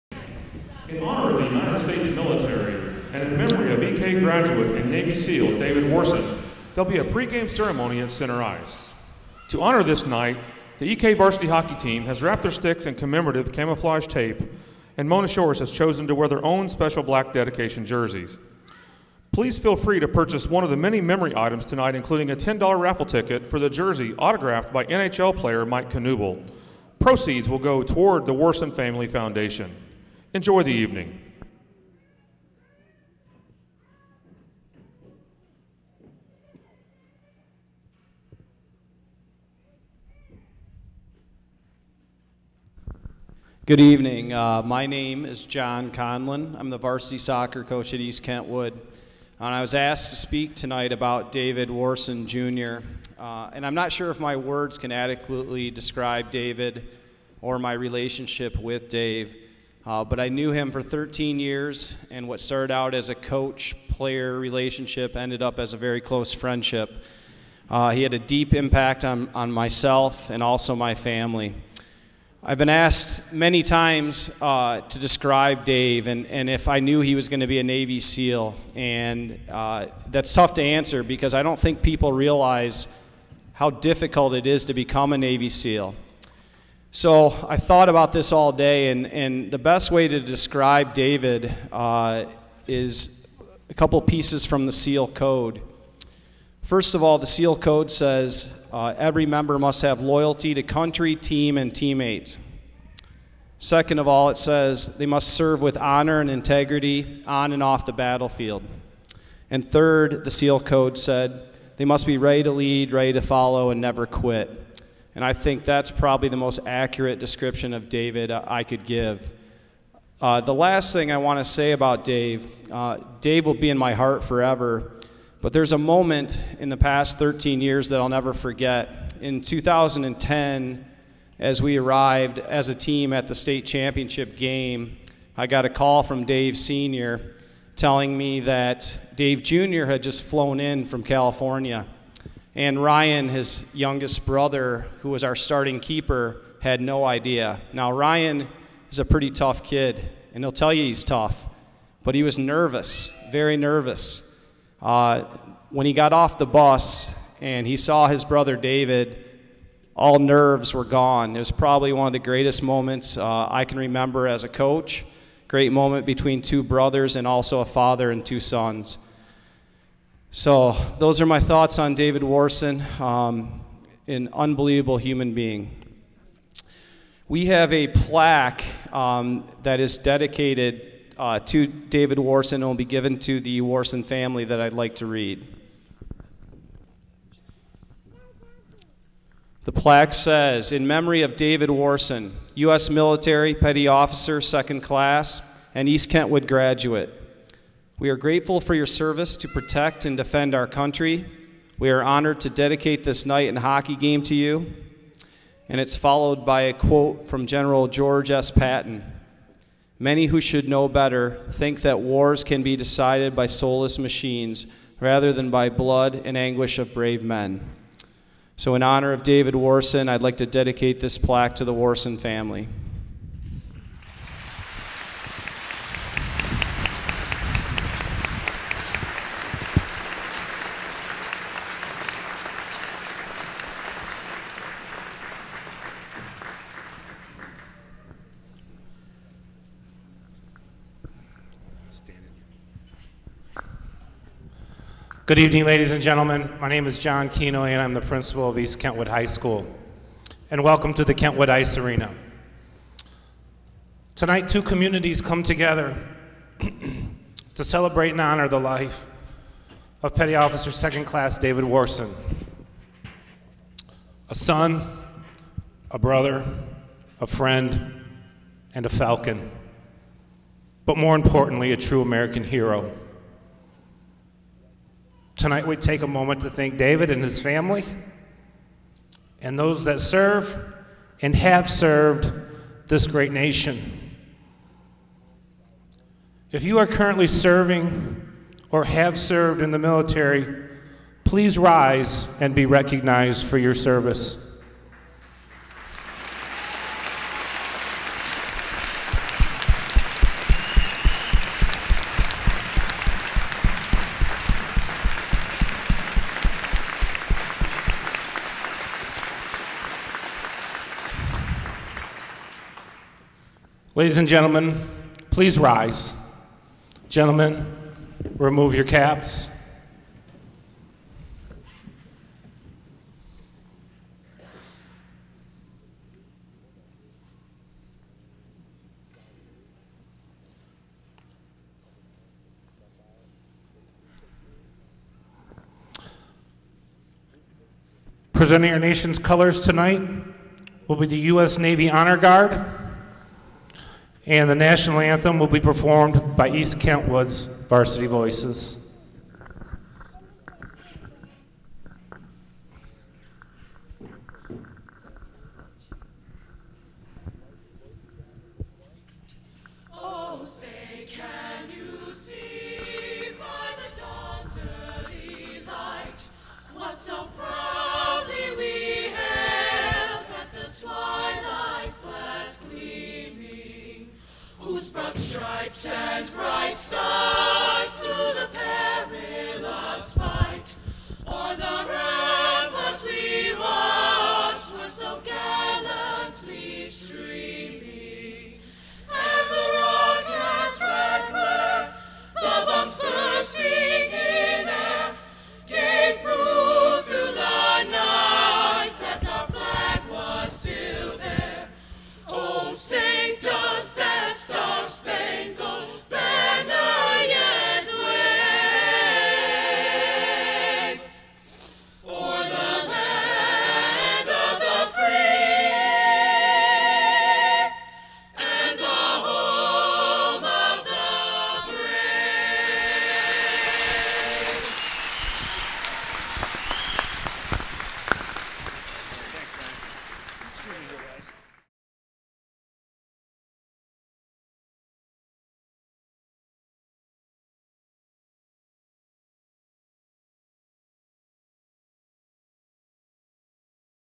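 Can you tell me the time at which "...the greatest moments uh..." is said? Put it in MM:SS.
02:42.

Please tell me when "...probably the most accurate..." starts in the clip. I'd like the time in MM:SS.
01:55.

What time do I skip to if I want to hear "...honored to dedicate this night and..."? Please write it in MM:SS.
03:22.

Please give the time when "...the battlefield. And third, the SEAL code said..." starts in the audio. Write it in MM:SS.
01:47.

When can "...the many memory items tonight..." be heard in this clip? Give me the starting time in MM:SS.
00:20.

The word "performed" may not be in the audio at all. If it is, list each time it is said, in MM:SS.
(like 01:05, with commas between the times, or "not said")
05:45.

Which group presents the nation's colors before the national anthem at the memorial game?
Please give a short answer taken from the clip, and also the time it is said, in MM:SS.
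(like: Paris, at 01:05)
U.S. Navy Honor Guard, at 05:41.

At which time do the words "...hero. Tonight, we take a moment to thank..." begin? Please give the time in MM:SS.
04:32.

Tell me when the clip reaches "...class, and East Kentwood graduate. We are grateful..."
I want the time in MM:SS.
03:14.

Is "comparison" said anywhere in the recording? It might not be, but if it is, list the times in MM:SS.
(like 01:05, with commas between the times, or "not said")
not said.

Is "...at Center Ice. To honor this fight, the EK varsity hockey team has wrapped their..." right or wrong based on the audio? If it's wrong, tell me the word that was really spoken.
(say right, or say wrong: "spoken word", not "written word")
wrong: "night", not "fight".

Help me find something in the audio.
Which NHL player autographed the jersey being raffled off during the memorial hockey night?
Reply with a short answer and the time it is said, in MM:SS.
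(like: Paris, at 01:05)
Mike Knuble, at 00:25.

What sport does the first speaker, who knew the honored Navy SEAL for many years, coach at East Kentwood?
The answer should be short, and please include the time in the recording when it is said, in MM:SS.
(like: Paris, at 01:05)
Soccer, at 00:47.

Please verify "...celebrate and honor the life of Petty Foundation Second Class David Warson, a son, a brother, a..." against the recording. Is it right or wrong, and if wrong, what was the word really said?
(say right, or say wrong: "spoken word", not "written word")
wrong: "Officer", not "Foundation".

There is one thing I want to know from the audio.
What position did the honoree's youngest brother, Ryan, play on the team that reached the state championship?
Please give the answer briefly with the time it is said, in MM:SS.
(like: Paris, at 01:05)
Keeper, at 02:25.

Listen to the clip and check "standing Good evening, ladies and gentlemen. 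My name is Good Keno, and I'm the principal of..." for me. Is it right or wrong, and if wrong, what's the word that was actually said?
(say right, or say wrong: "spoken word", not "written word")
wrong: "John", not "Good".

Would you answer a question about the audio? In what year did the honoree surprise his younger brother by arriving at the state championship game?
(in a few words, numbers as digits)
2010.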